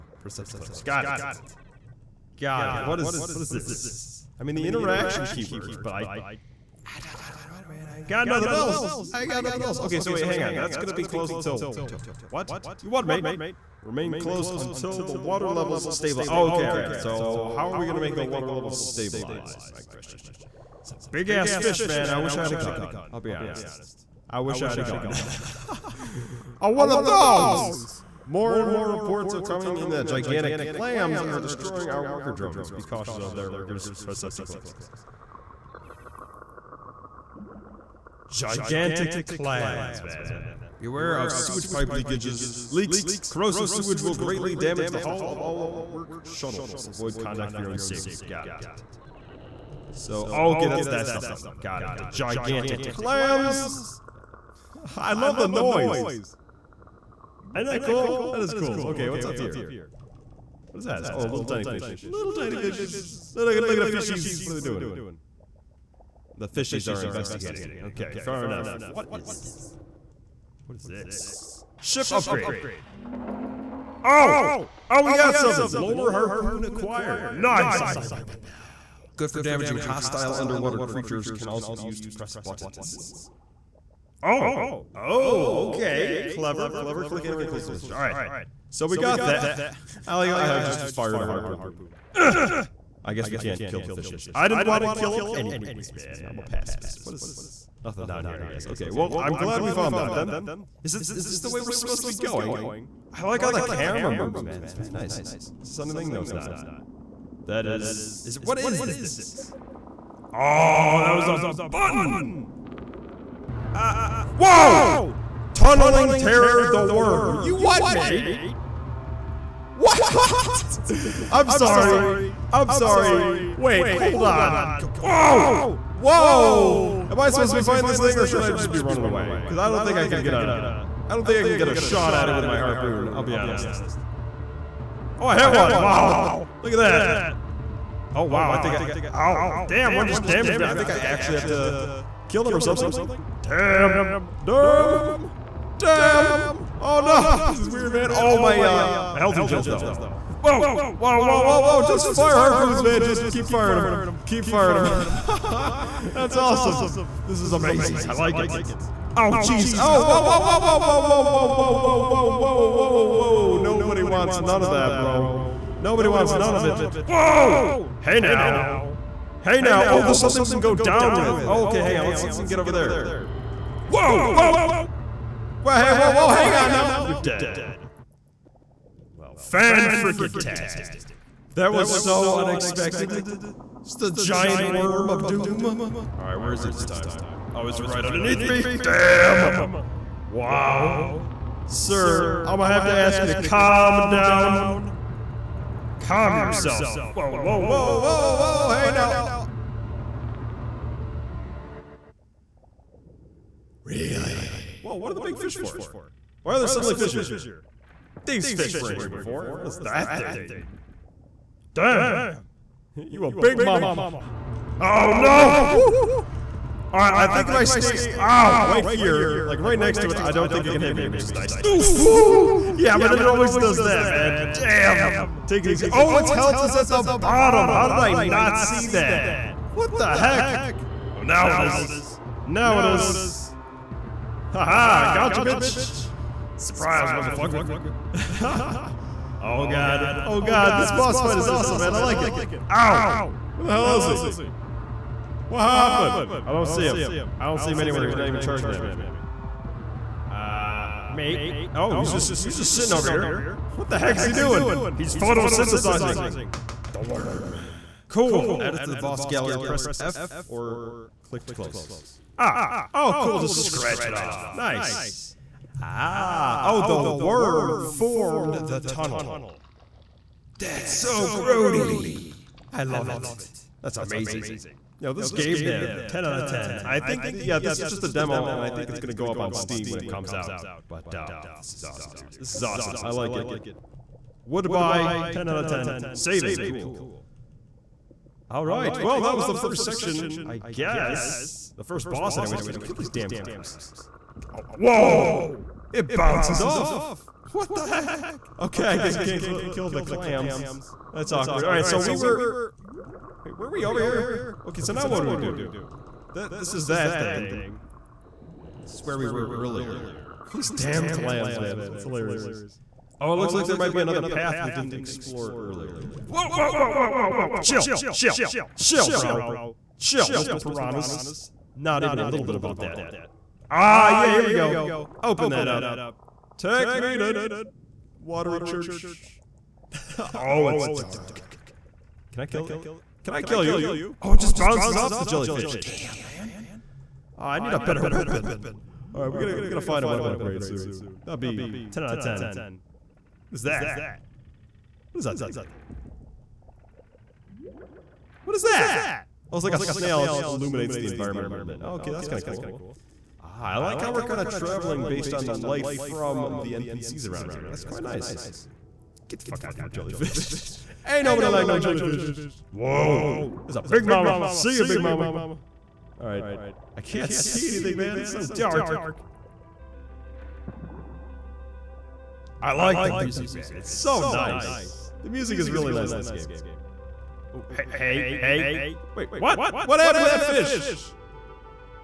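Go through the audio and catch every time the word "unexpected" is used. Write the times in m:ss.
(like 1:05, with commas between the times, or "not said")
3:02.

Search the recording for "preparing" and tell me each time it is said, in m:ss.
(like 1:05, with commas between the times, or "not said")
not said.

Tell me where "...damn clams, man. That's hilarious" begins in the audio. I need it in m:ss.
5:10.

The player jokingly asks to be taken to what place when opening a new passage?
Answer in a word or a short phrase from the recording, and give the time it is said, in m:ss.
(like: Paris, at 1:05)
Watery Church, at 5:28.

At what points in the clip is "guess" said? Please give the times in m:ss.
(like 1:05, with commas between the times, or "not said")
1:33, 1:38, 4:50, 4:58.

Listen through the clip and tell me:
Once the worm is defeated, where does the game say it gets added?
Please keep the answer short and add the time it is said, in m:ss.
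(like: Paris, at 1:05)
boss gallery, at 4:18.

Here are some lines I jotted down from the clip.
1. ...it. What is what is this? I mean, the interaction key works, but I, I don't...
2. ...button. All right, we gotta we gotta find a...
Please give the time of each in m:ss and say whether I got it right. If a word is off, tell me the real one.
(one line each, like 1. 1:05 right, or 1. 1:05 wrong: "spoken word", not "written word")
1. 0:02 right
2. 5:38 wrong: "weapon", not "button".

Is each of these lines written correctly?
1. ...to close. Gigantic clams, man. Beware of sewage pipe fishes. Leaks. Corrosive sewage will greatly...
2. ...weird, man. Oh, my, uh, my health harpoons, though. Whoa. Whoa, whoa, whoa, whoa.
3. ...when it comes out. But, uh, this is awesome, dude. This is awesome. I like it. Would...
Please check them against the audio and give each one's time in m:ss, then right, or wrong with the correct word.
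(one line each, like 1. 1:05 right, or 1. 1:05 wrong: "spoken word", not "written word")
1. 0:34 wrong: "leakages", not "fishes"
2. 2:27 wrong: "regens", not "harpoons"
3. 4:39 right.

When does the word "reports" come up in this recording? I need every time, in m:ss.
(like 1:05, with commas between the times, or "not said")
0:28.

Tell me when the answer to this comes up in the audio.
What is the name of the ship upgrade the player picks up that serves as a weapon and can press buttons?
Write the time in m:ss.
1:15.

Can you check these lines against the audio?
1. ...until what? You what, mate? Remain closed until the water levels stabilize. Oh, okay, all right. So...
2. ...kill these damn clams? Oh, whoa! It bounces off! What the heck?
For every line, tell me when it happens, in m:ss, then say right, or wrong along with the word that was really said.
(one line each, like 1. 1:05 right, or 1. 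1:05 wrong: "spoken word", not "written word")
1. 0:11 right
2. 4:52 right.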